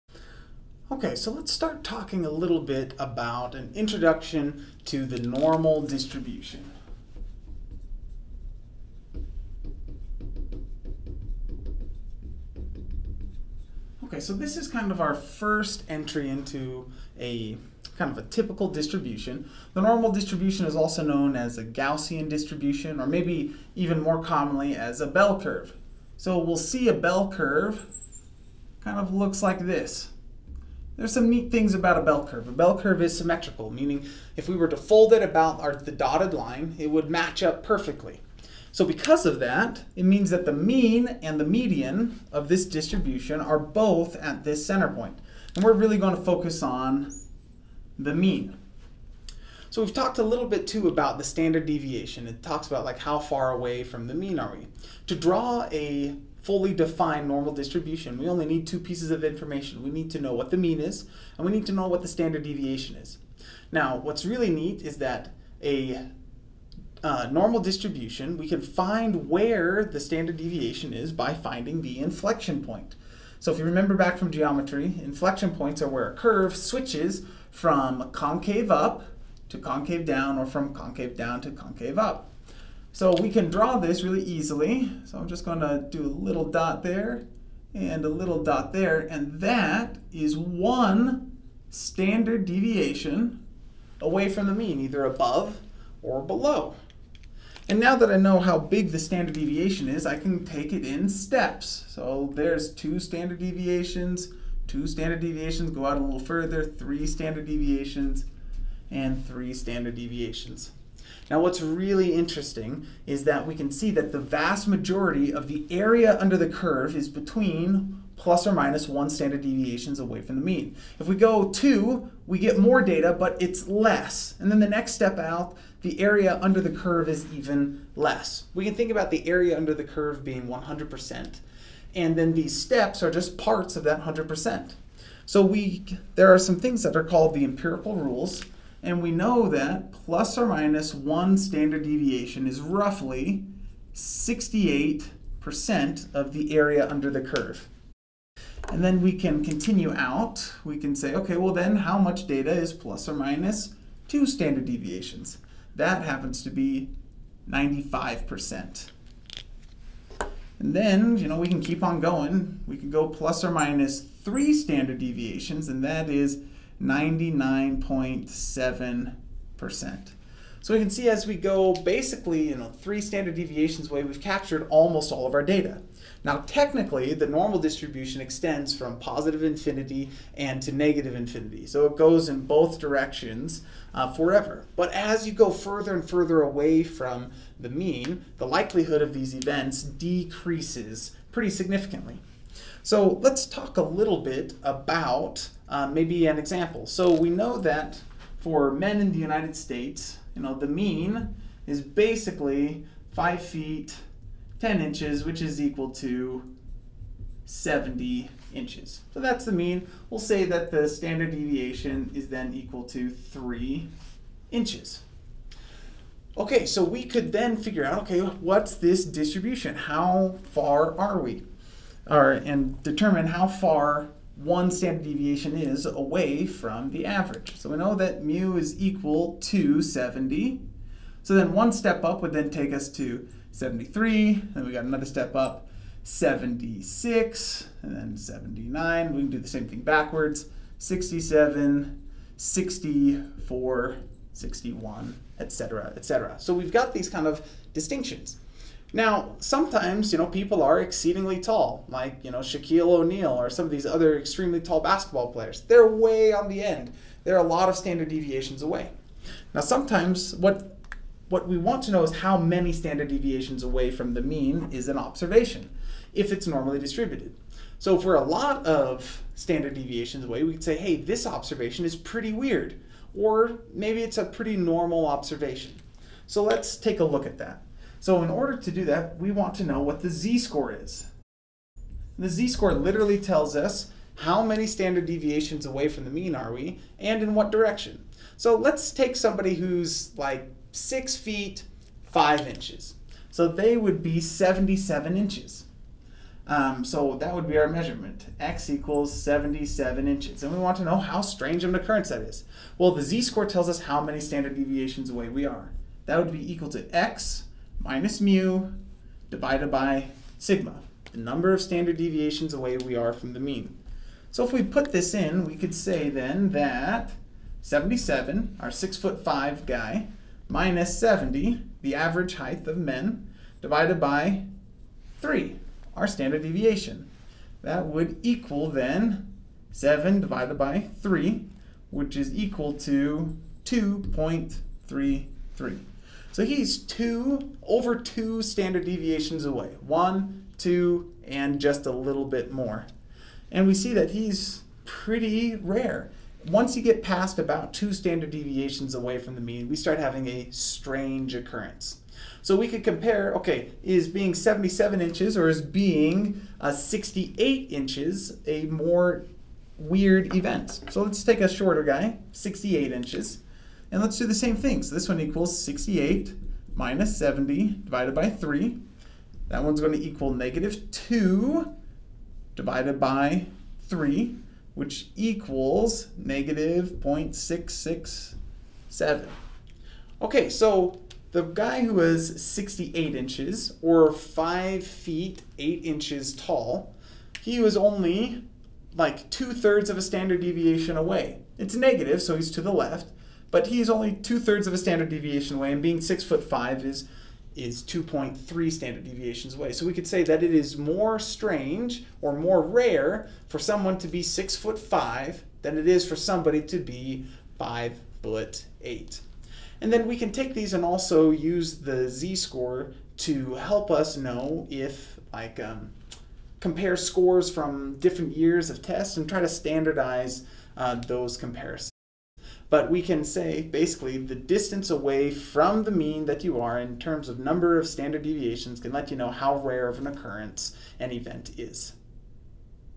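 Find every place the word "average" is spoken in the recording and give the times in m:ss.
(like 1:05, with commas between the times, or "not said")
3:47, 5:21.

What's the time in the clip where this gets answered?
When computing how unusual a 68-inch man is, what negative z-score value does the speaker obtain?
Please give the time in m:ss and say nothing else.
6:16.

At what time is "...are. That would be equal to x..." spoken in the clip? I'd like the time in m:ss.
5:05.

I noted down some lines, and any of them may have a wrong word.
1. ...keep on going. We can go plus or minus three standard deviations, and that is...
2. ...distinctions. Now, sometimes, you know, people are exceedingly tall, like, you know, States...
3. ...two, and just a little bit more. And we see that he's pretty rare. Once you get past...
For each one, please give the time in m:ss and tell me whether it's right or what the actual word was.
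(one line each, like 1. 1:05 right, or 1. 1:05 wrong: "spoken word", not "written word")
1. 2:41 right
2. 4:07 wrong: "Shaquille", not "States"
3. 5:40 right.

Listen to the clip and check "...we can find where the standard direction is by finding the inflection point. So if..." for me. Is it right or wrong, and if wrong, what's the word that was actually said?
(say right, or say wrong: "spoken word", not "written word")
wrong: "deviation", not "direction".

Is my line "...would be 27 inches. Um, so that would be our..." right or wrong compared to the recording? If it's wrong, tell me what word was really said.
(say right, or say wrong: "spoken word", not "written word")
wrong: "77", not "27".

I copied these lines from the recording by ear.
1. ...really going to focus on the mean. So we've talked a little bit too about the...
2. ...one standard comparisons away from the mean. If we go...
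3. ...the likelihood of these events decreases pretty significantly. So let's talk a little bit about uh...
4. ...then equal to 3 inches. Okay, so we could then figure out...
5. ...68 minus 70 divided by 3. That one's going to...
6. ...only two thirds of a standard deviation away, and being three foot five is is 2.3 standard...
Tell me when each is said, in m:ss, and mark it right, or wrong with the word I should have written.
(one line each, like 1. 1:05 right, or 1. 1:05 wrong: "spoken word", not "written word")
1. 0:45 right
2. 1:58 wrong: "deviations", not "comparisons"
3. 3:08 right
4. 3:32 right
5. 6:05 right
6. 6:33 wrong: "six", not "three".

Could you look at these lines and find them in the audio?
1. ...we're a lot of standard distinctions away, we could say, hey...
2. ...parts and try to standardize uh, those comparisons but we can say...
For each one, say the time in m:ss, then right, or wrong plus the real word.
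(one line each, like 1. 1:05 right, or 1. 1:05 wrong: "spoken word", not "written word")
1. 4:28 wrong: "deviations", not "distinctions"
2. 6:58 wrong: "tests", not "parts".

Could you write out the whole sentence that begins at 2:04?
And then the next step out, the area under the curve is even less.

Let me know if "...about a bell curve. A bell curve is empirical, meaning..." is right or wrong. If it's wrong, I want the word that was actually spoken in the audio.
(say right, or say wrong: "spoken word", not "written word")
wrong: "symmetrical", not "empirical".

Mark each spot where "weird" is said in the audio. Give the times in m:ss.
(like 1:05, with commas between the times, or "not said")
4:32, 5:59.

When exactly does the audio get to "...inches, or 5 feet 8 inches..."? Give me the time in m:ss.
6:23.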